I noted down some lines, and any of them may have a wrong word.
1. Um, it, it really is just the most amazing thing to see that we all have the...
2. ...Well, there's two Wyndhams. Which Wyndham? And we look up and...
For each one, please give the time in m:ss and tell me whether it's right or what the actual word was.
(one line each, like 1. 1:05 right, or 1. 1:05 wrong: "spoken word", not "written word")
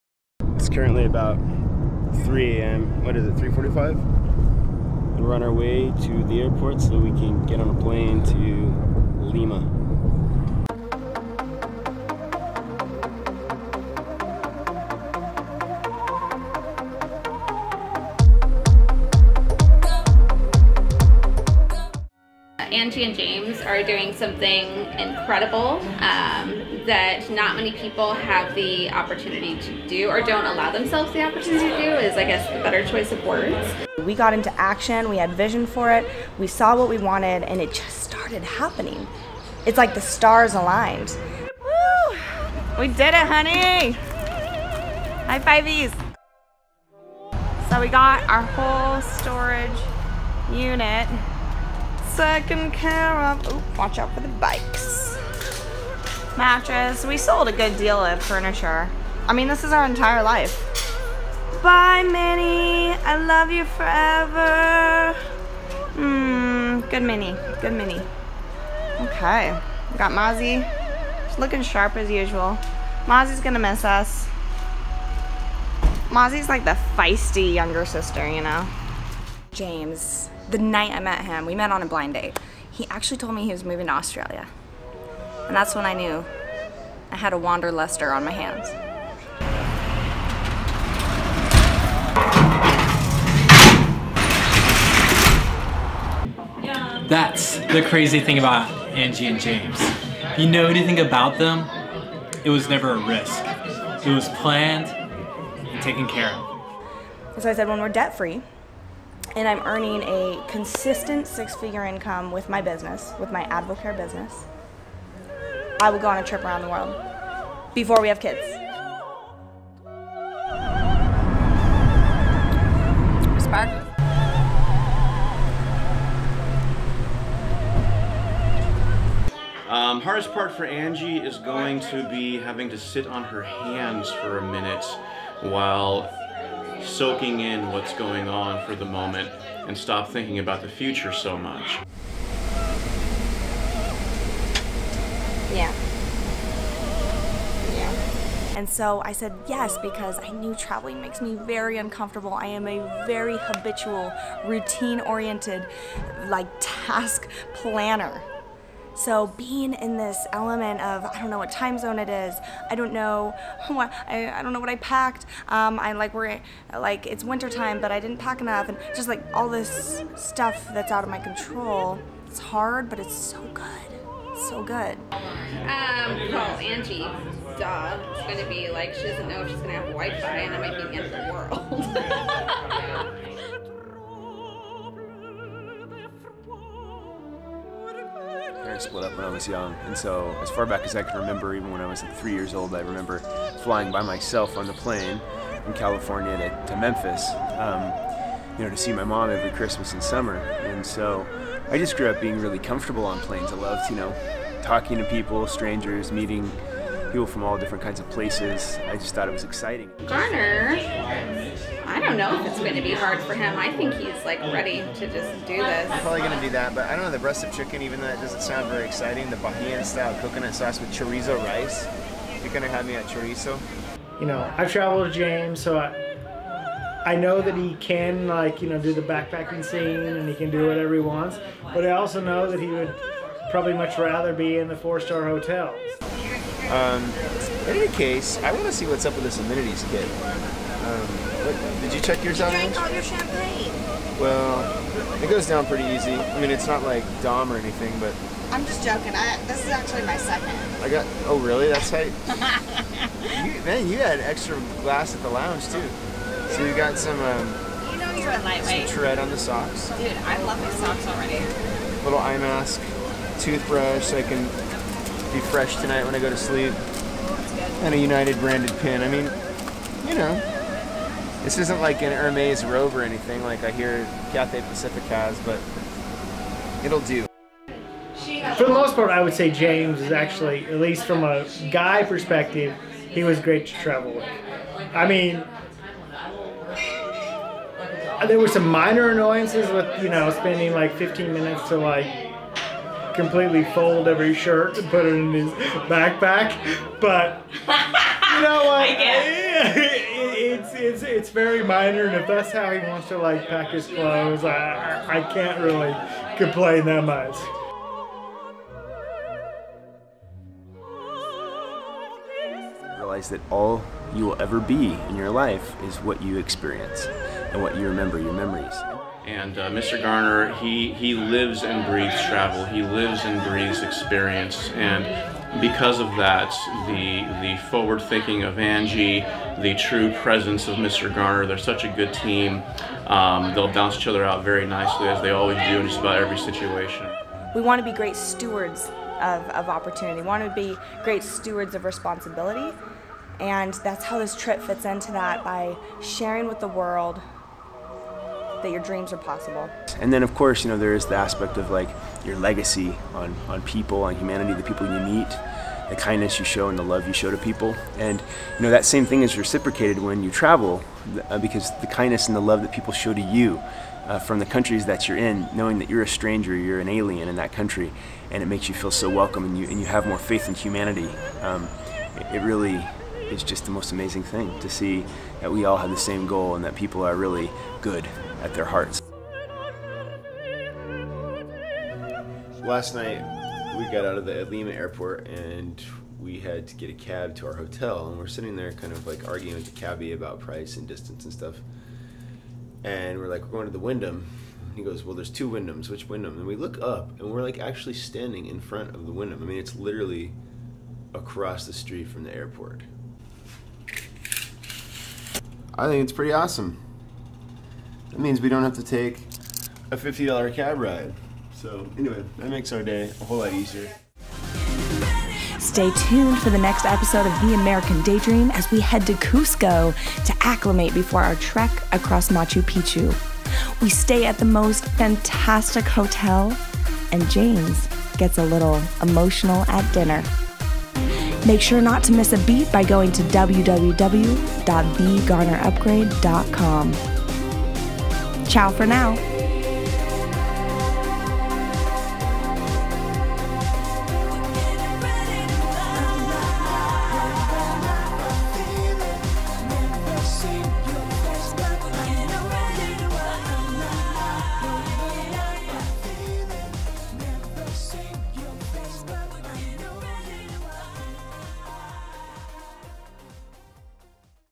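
1. 6:11 right
2. 6:35 right.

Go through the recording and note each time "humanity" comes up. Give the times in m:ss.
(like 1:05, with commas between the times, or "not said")
5:54, 6:10.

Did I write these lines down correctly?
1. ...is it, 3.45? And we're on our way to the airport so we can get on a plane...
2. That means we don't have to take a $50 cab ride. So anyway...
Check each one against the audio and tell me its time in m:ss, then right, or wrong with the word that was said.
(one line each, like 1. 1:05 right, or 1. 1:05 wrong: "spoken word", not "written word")
1. 0:03 right
2. 6:48 right.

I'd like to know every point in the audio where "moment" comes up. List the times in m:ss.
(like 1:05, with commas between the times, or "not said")
2:18.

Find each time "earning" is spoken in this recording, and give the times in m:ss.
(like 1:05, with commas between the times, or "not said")
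1:49.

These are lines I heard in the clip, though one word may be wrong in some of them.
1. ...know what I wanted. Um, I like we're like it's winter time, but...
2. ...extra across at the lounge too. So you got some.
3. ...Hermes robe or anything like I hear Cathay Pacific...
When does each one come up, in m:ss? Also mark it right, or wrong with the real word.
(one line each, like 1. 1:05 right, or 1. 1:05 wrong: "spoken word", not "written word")
1. 2:44 wrong: "packed", not "wanted"
2. 4:14 wrong: "glass", not "across"
3. 4:32 right.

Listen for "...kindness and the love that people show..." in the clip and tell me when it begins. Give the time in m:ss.
6:01.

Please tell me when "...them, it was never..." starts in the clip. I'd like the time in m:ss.
1:41.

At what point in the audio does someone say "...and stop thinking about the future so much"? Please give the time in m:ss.
2:19.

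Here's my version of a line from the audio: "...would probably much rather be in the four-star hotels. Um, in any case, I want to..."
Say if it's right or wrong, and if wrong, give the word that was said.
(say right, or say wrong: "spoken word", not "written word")
right.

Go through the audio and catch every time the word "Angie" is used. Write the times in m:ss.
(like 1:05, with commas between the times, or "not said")
0:22, 1:38, 2:10, 2:56, 5:28.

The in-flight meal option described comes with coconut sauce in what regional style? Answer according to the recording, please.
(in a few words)
Bahian.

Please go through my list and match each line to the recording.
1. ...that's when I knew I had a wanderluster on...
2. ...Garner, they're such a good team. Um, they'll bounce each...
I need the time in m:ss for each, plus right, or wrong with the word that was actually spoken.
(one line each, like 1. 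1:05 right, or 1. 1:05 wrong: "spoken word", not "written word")
1. 1:25 right
2. 5:31 right.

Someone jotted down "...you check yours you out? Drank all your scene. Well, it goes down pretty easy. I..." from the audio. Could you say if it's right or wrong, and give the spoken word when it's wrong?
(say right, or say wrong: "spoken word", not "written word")
wrong: "champagne", not "scene".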